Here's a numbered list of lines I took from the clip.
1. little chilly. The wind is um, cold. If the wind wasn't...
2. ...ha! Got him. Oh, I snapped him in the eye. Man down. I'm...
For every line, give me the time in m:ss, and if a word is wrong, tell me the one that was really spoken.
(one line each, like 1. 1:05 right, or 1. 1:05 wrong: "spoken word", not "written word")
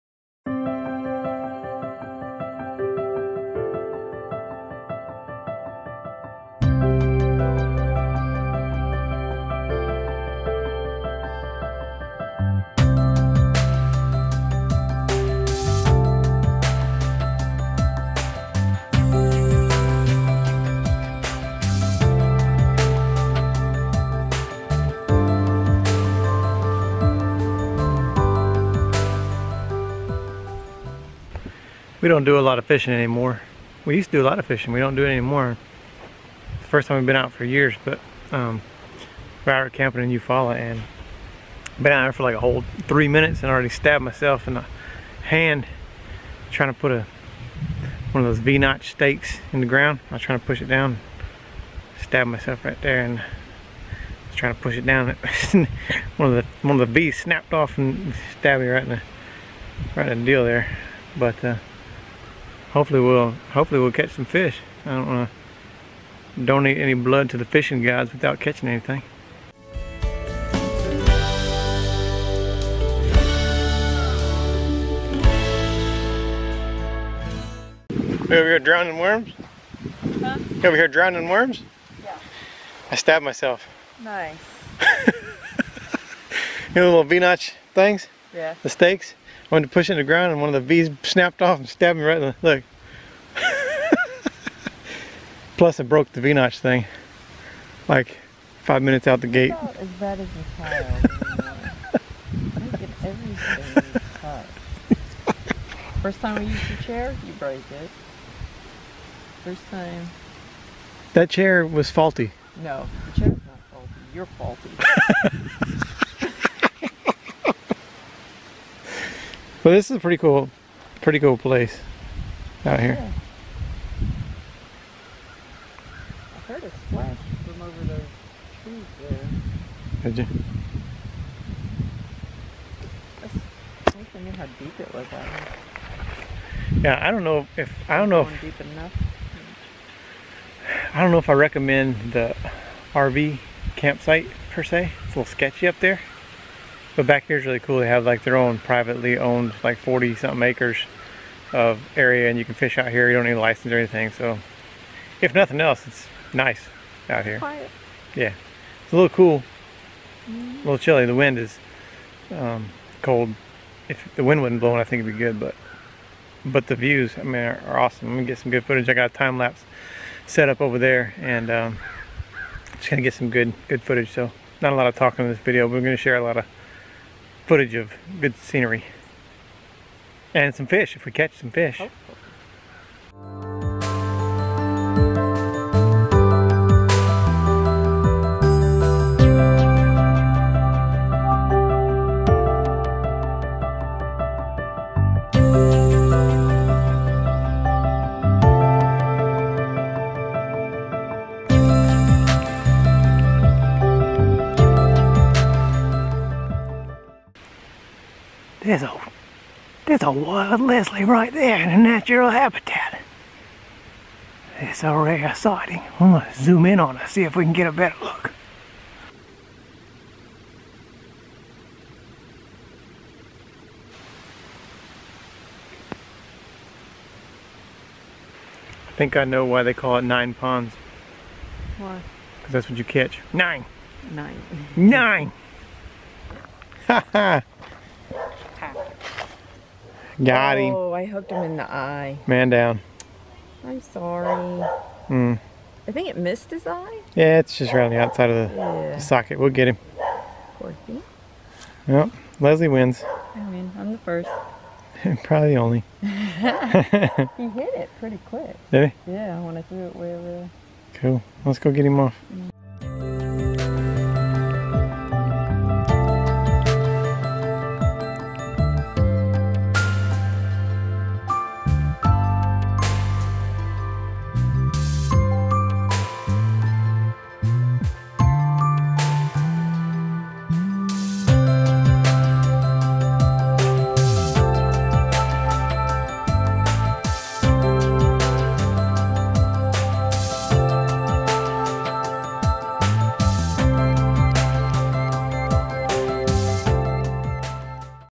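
1. 2:40 right
2. 3:57 wrong: "hooked", not "snapped".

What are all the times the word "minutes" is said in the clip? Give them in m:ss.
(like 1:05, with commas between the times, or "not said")
0:43, 1:38.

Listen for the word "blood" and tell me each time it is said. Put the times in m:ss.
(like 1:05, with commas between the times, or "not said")
1:06.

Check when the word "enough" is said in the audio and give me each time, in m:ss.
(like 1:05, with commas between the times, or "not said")
2:18.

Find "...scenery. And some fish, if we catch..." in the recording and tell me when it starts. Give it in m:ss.
2:58.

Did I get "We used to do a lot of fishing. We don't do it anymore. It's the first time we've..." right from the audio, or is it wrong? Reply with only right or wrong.
right.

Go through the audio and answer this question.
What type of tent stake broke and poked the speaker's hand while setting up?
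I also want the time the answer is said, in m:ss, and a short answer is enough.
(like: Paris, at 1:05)
V-notch stakes, at 0:48.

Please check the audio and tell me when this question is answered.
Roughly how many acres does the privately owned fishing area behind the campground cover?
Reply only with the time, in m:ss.
2:29.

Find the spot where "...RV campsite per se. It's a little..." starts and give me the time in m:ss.
2:22.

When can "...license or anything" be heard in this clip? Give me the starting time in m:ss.
2:33.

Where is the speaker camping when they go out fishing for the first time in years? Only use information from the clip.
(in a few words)
Eufaula.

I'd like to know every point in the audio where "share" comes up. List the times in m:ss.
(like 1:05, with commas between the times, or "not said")
2:55.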